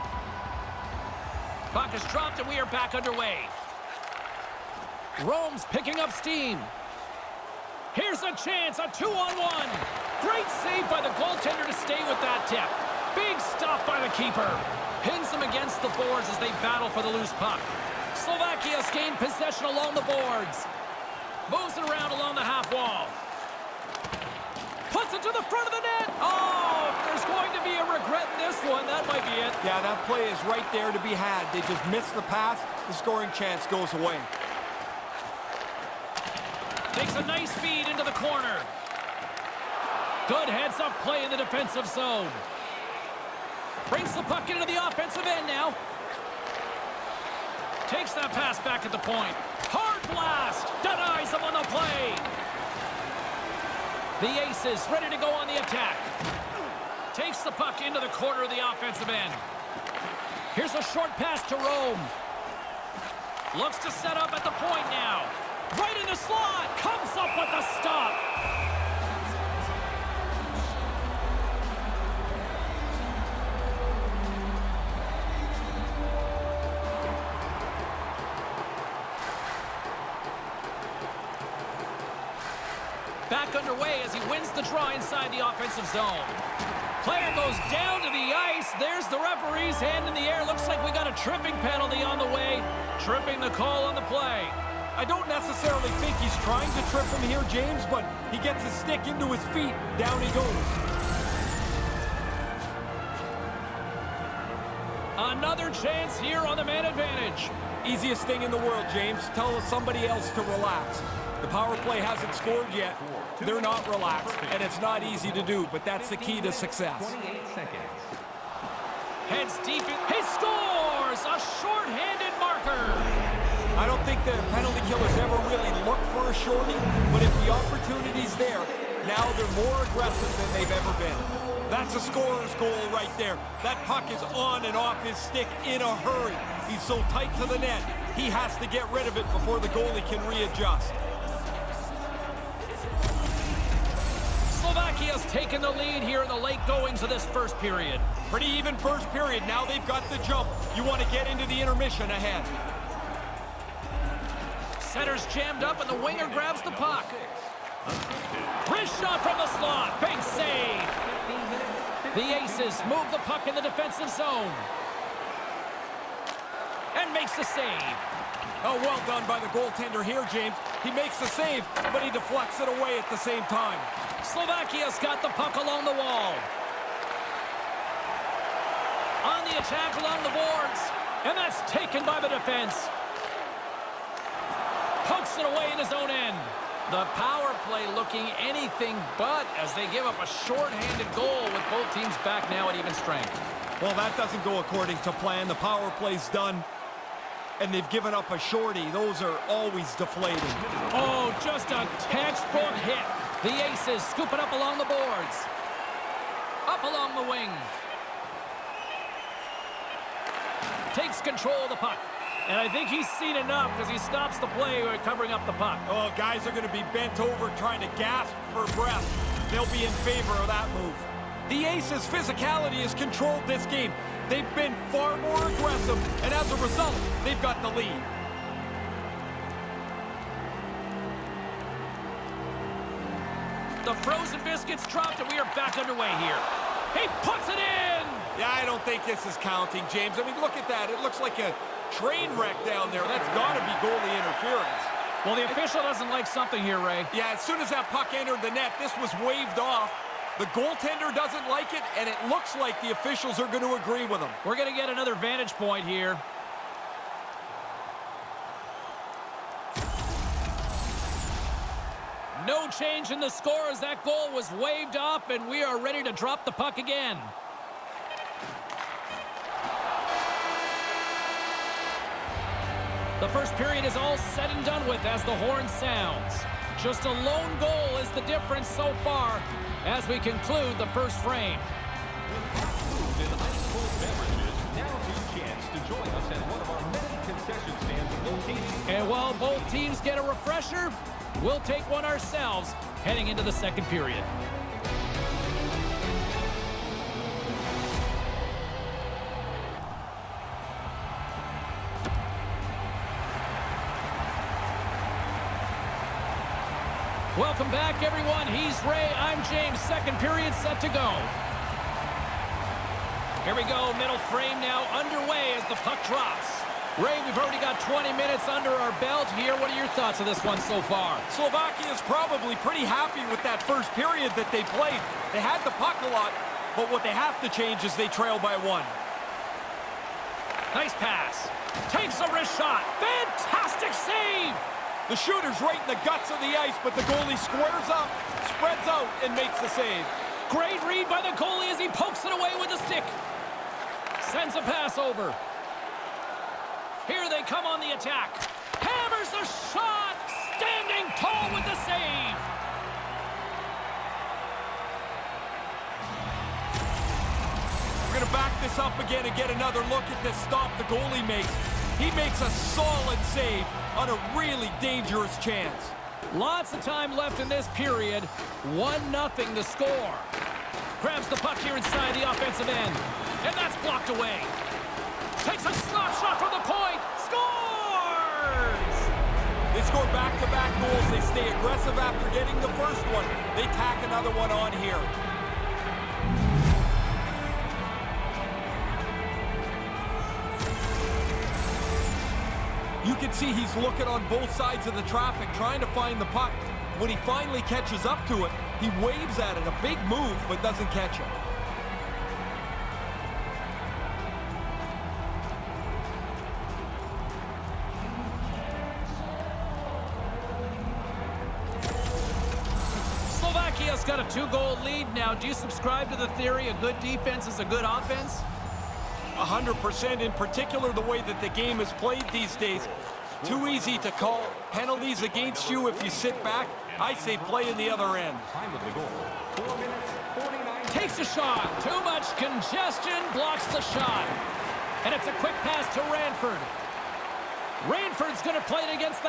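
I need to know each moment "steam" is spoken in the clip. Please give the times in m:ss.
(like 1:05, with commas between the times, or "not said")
0:06.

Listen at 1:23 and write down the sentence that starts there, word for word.
Back underway as he wins the draw inside the offensive zone.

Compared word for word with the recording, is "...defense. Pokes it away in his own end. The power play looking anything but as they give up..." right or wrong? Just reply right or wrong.
right.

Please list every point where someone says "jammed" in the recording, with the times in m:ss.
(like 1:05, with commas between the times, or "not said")
2:35.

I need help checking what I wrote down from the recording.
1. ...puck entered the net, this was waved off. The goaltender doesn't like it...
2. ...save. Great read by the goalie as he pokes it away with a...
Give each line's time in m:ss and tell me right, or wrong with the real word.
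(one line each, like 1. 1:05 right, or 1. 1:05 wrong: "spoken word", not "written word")
1. 4:07 right
2. 5:39 right.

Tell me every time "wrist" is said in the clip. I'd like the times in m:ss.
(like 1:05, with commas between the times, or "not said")
2:38, 5:32.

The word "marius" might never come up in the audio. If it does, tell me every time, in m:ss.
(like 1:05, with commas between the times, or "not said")
not said.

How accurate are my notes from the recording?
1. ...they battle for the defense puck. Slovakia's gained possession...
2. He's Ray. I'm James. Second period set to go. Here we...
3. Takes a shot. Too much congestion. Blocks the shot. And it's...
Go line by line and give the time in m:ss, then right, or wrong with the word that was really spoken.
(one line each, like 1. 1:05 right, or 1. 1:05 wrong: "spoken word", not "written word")
1. 0:16 wrong: "loose", not "defense"
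2. 5:08 right
3. 7:10 right.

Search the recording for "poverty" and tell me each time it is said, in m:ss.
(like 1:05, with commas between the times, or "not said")
not said.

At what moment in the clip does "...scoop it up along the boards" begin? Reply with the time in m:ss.
3:24.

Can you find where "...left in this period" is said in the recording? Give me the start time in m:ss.
6:07.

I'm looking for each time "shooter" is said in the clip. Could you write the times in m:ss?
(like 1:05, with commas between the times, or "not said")
5:35.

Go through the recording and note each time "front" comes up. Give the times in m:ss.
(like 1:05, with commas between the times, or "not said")
0:25.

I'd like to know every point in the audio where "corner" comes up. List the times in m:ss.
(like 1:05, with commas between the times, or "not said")
0:38, 0:58.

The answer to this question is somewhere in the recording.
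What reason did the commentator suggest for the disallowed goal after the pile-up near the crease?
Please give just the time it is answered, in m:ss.
4:03.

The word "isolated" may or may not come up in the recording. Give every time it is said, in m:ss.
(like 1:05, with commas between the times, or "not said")
not said.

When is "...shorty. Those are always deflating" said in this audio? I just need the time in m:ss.
3:18.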